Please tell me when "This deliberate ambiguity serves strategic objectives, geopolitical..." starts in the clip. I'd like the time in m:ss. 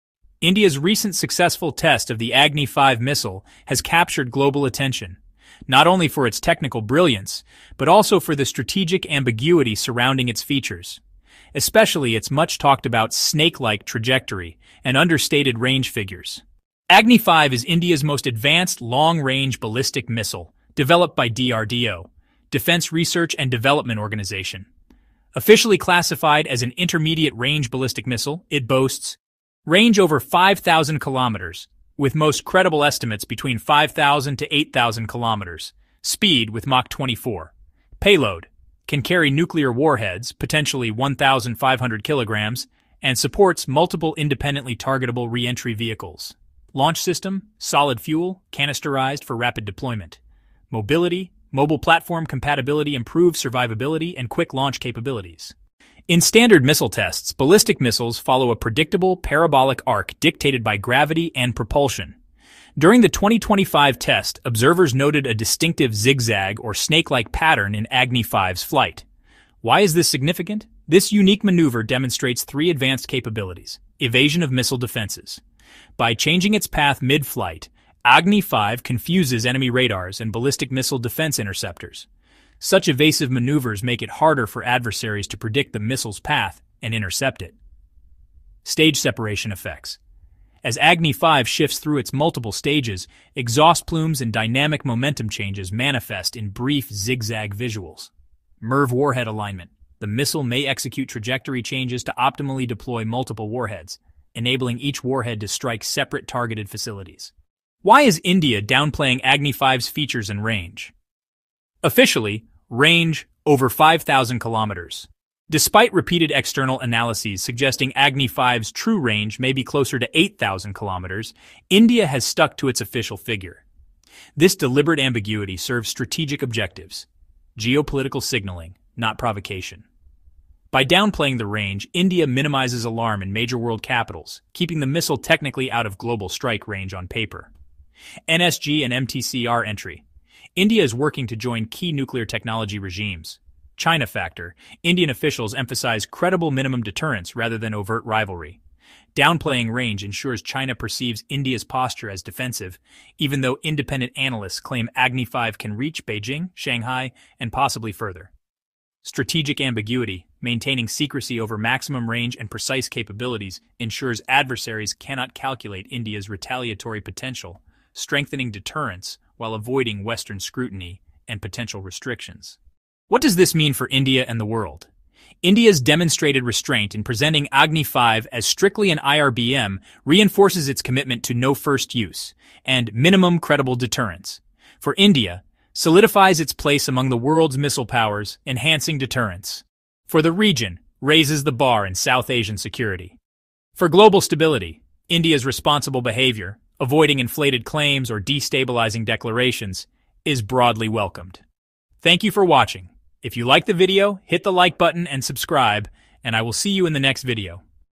2:04.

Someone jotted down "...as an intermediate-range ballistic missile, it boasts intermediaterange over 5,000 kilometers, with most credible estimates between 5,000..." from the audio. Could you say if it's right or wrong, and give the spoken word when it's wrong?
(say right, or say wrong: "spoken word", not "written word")
wrong: "range", not "intermediaterange".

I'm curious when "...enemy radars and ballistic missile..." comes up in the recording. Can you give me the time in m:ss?
1:19.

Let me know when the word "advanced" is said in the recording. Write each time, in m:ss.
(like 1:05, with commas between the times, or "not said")
0:18, 1:12.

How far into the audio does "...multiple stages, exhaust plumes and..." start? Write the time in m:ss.
1:32.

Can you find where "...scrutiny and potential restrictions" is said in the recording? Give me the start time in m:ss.
2:50.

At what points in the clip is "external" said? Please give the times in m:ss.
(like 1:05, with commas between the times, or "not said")
1:56.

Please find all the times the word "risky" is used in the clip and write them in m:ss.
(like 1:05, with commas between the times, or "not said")
not said.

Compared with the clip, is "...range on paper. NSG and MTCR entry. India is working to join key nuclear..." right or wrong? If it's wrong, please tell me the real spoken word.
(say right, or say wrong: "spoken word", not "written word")
right.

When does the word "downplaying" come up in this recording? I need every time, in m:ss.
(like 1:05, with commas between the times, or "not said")
1:48, 2:10, 2:29.